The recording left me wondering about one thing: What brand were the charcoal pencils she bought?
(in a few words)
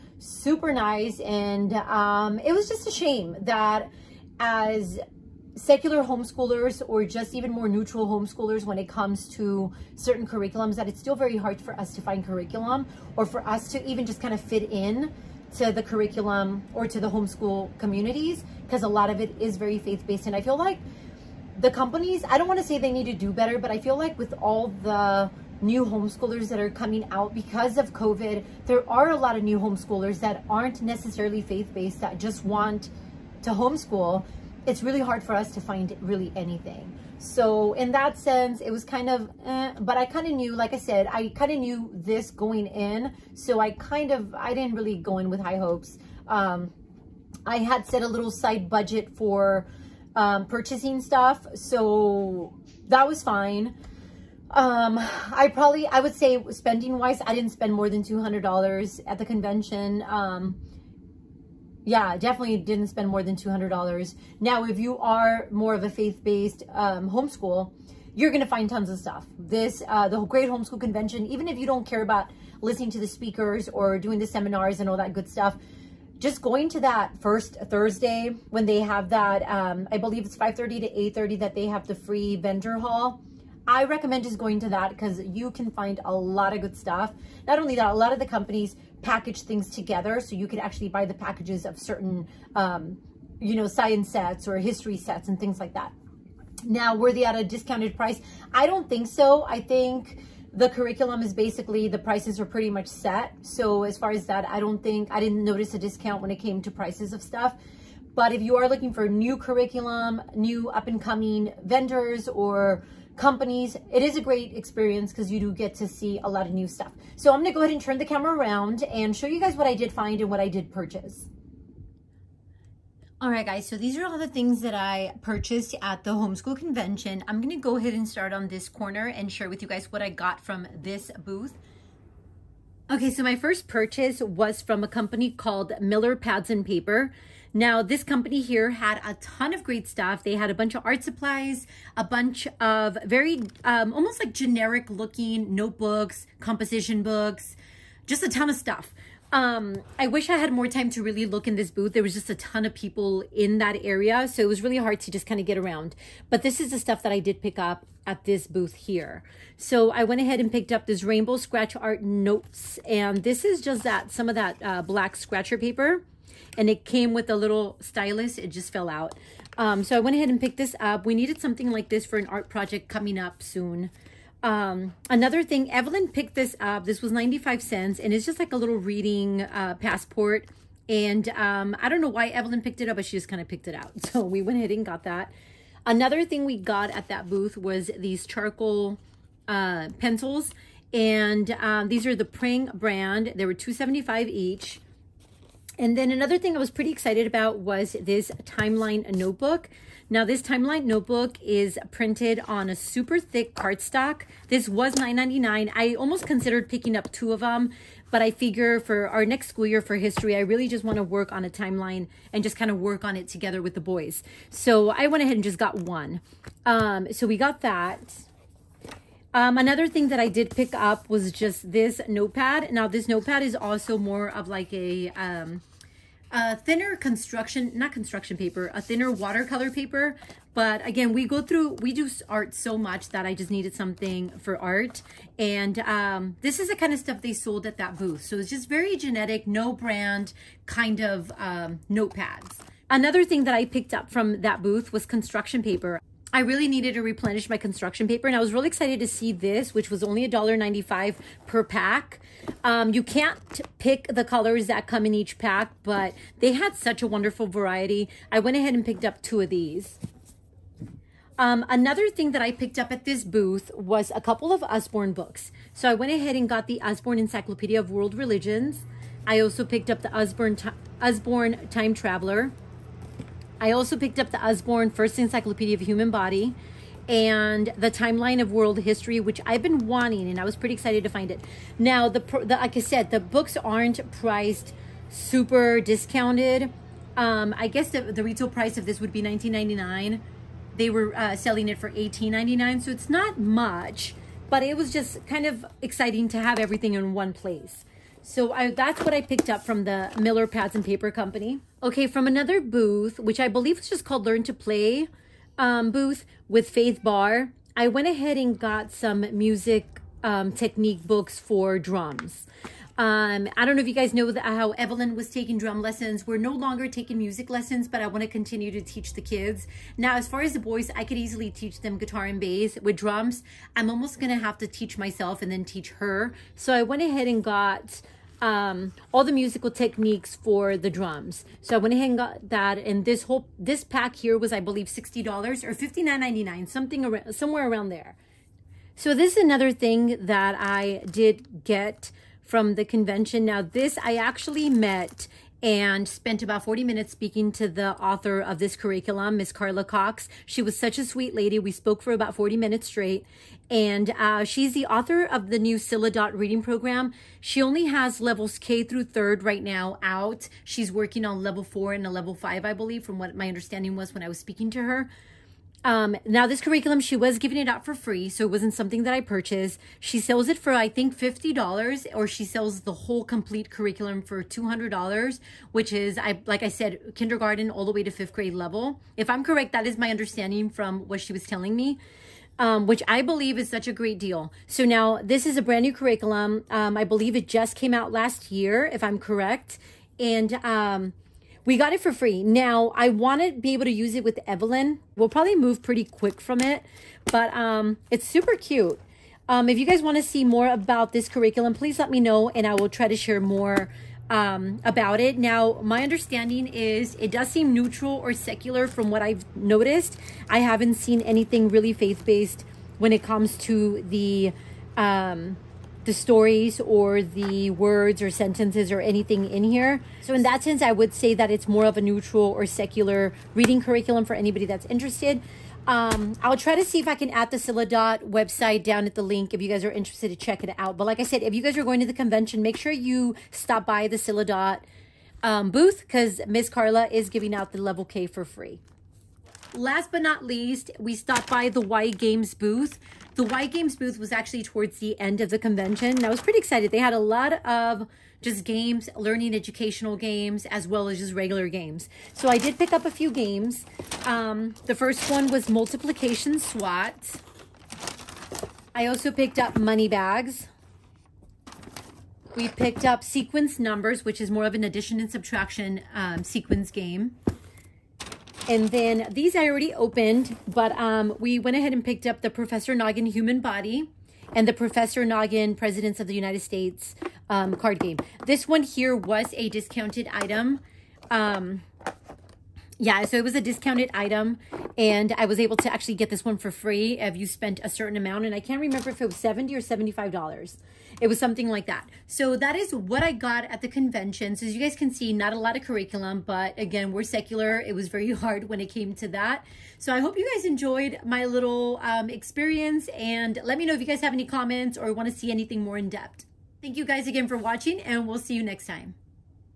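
Prang.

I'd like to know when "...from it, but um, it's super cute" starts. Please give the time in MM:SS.
06:36.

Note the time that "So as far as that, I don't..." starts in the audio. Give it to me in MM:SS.
01:43.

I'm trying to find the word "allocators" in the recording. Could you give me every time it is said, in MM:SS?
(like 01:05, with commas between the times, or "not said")
not said.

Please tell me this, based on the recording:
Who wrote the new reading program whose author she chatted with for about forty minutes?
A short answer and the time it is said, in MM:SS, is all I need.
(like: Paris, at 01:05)
Carla Cox, at 05:49.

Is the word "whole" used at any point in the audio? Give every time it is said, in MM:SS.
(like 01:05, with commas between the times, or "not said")
05:33, 06:13.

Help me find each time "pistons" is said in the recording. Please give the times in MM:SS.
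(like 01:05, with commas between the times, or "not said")
not said.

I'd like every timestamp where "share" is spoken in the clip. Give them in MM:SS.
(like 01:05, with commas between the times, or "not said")
02:09, 06:43.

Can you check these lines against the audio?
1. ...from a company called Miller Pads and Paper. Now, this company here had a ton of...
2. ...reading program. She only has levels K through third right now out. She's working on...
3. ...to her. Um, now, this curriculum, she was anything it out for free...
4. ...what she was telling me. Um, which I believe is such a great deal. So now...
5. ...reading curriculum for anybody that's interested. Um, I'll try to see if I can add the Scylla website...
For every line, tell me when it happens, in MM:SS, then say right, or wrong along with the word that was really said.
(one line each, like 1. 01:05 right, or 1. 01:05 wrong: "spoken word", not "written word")
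1. 02:14 right
2. 05:56 right
3. 06:04 wrong: "giving", not "anything"
4. 06:20 right
5. 07:03 right.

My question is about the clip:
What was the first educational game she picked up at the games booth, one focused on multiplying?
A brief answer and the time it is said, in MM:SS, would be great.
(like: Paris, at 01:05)
Multiplication SWAT, at 07:35.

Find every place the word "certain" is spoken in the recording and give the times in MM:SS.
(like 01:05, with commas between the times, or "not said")
00:09, 01:31, 08:07.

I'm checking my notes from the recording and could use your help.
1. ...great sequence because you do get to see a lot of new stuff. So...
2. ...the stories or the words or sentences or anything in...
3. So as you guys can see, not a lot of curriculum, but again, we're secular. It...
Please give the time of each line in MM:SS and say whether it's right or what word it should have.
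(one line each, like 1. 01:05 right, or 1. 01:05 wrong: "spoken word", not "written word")
1. 01:54 wrong: "experience", not "sequence"
2. 06:56 right
3. 08:14 right.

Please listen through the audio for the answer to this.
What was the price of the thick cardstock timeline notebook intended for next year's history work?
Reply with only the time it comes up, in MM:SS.
03:24.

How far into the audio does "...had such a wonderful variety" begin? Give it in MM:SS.
04:16.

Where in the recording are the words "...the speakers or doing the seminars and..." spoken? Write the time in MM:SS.
01:12.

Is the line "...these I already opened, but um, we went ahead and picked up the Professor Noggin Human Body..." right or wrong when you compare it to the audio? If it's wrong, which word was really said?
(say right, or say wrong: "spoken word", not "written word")
right.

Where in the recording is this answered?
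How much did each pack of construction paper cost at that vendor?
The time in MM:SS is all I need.
04:10.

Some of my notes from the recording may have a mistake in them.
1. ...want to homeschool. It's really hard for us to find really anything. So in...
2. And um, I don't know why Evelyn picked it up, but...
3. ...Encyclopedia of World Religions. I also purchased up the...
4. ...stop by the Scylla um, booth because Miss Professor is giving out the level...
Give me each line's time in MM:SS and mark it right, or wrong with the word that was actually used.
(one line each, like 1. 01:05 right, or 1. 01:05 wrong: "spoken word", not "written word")
1. 00:32 right
2. 03:00 right
3. 04:27 wrong: "picked", not "purchased"
4. 07:13 wrong: "Carla", not "Professor".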